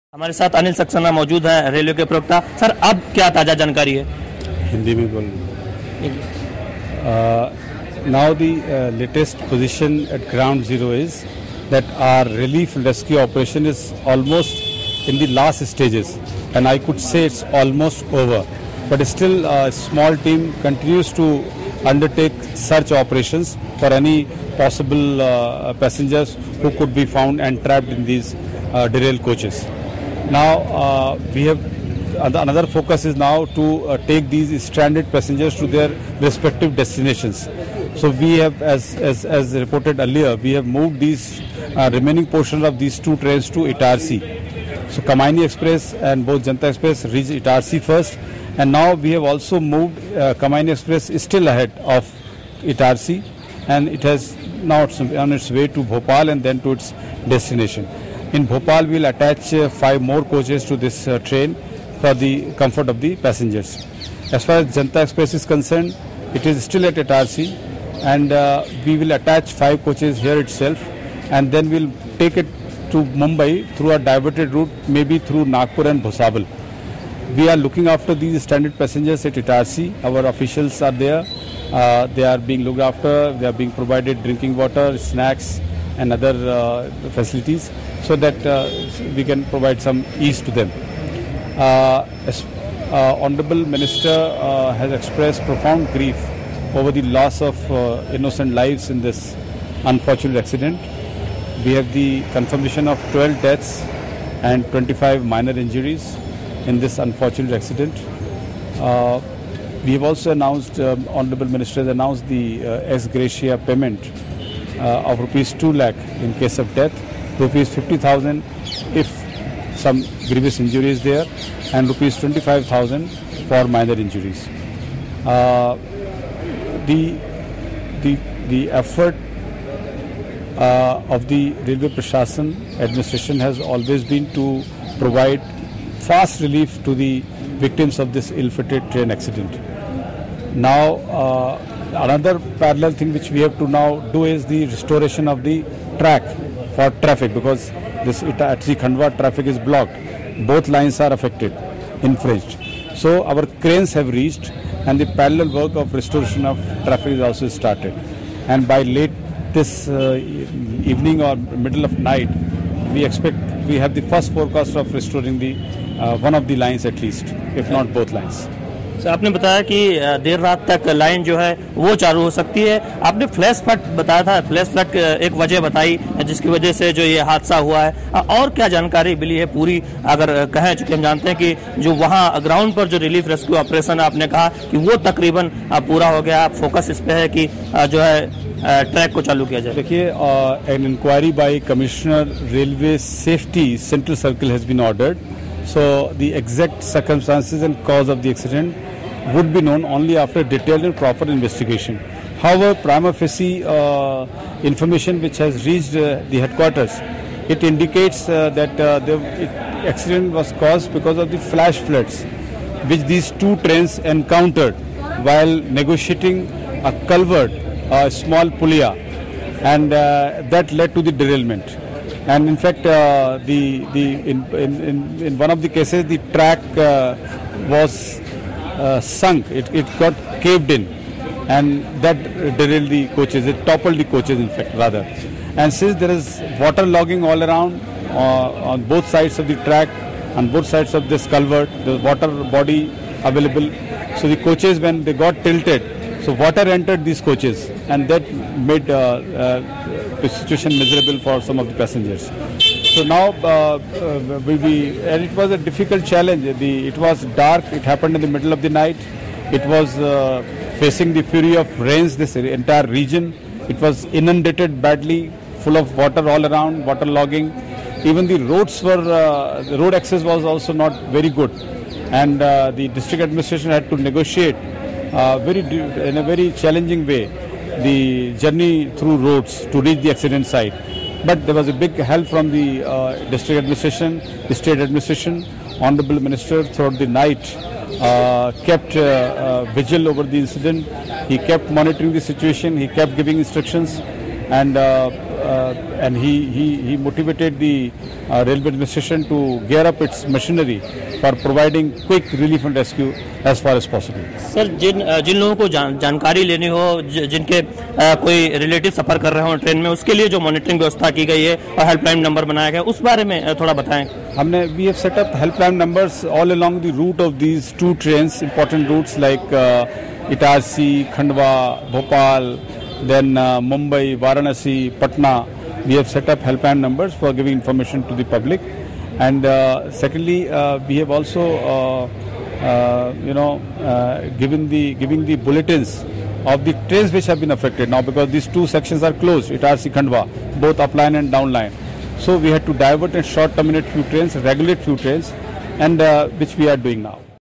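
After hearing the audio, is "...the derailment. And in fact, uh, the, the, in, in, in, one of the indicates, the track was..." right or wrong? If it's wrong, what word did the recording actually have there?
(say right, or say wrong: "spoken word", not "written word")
wrong: "cases", not "indicates".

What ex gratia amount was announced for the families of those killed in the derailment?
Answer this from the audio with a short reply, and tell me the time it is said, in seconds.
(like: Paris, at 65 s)
Rupees 2 lakh, at 115 s.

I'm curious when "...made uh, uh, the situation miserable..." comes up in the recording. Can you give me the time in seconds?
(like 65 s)
248 s.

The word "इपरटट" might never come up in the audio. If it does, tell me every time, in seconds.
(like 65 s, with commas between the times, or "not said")
318 s.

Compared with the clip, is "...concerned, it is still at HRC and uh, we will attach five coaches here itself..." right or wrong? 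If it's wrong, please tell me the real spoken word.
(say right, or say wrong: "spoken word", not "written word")
right.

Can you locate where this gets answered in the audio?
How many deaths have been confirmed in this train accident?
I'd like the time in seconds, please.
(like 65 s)
103 s.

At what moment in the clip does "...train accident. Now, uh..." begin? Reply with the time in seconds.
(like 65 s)
138 s.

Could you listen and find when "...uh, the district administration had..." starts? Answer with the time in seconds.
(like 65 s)
272 s.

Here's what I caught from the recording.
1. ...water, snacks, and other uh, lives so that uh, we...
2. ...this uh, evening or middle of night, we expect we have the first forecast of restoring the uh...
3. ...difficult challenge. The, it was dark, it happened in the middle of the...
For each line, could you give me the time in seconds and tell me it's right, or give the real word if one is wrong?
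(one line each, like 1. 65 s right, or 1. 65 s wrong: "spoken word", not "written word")
1. 84 s wrong: "facilities", not "lives"
2. 159 s right
3. 255 s right.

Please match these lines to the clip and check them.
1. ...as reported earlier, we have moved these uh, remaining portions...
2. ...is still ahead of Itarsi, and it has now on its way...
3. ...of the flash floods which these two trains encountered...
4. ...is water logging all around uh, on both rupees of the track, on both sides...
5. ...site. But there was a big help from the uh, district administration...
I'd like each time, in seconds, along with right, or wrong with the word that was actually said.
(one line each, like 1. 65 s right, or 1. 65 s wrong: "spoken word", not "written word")
1. 39 s right
2. 51 s right
3. 211 s right
4. 236 s wrong: "sides", not "rupees"
5. 280 s right.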